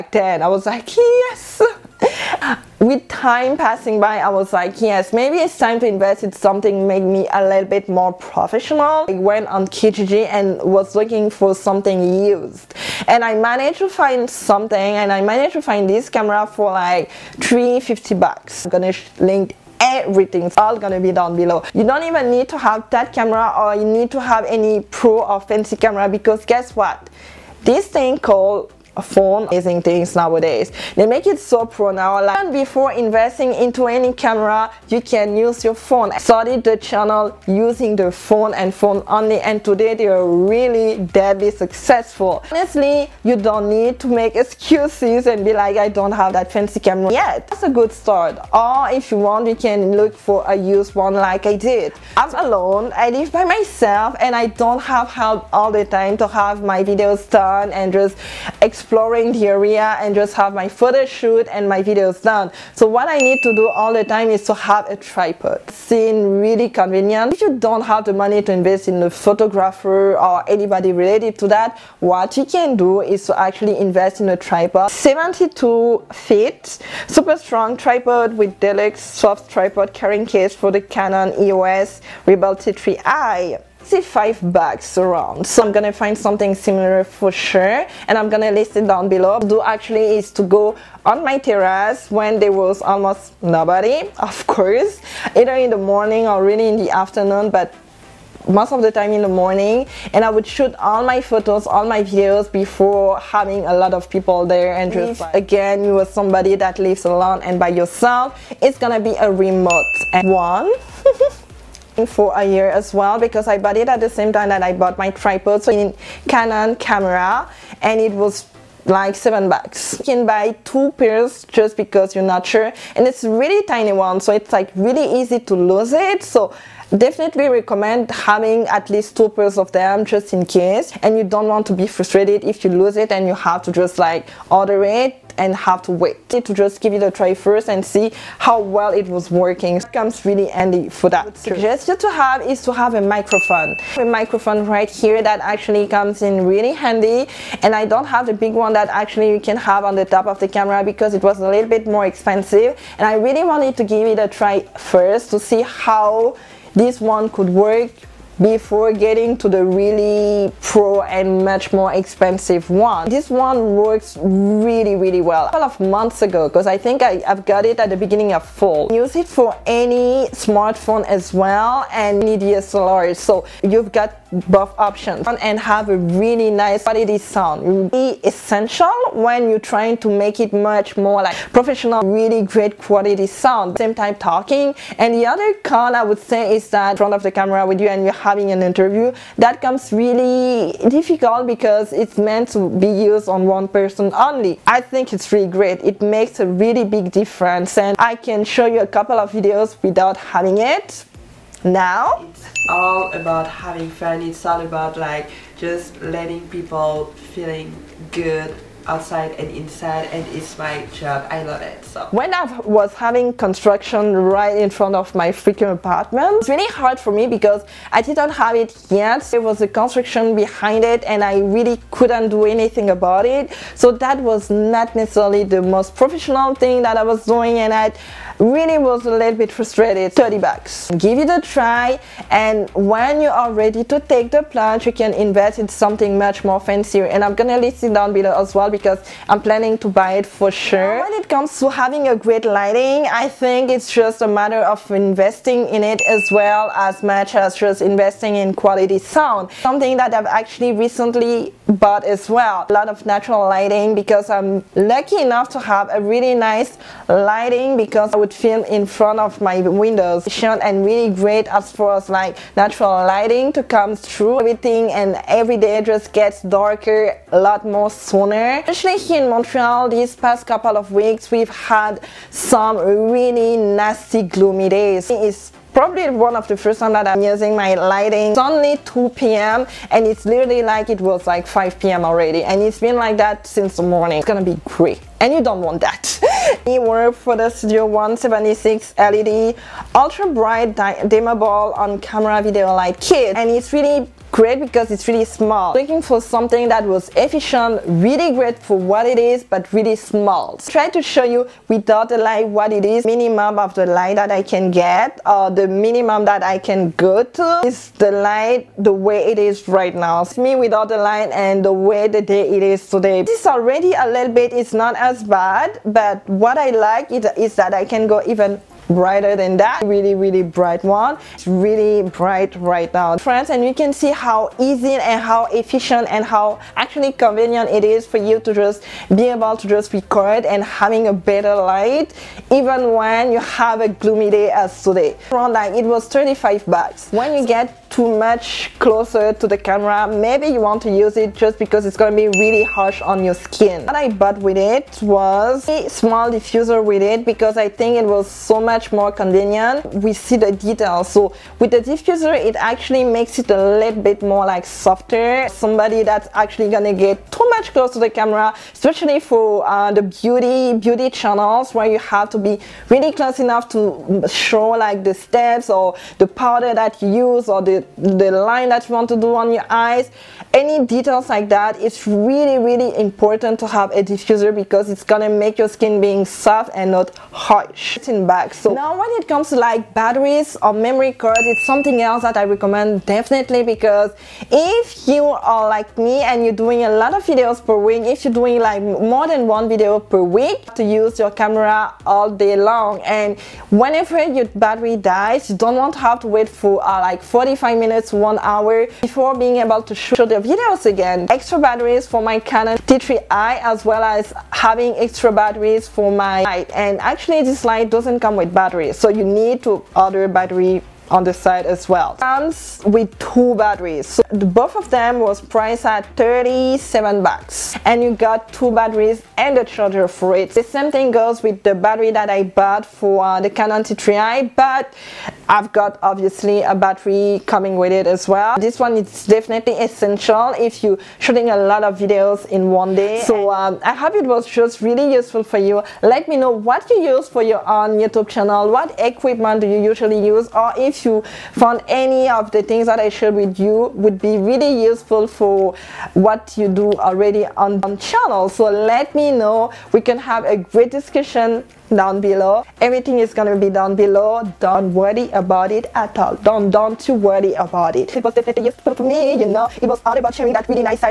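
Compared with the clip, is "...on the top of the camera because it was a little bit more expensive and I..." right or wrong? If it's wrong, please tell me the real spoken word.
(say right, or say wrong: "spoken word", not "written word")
right.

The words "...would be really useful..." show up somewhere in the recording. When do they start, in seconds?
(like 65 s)
443 s.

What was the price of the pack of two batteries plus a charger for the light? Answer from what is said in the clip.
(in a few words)
$37.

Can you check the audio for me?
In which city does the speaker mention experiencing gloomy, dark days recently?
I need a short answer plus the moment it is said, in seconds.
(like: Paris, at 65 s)
Montreal, at 269 s.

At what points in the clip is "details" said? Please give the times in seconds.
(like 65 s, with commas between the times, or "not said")
350 s, 370 s.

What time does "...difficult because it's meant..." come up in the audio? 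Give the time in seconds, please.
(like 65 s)
190 s.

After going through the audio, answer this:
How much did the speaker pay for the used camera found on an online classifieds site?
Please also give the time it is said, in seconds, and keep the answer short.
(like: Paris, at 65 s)
$350, at 17 s.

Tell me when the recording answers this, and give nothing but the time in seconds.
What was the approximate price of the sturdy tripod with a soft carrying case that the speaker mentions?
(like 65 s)
83 s.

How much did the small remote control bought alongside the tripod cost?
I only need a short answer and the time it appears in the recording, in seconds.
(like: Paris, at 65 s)
$7, at 119 s.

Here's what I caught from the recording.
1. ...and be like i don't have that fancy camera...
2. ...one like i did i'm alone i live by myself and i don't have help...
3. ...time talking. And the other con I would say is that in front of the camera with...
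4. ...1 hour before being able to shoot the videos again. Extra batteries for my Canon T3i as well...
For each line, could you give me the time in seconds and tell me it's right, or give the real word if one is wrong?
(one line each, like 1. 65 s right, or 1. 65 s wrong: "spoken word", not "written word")
1. 45 s right
2. 50 s right
3. 183 s right
4. 398 s right.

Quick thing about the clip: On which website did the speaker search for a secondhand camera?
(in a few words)
Kijiji.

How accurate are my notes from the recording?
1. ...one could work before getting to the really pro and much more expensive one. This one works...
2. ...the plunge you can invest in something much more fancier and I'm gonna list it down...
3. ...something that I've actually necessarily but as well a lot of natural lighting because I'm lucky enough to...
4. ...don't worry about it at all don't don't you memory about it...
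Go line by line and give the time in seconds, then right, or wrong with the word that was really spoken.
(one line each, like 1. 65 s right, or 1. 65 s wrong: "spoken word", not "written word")
1. 157 s right
2. 234 s right
3. 249 s wrong: "recently", not "necessarily"
4. 454 s wrong: "worry", not "memory".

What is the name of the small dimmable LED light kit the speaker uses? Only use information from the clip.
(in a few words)
Studio 176.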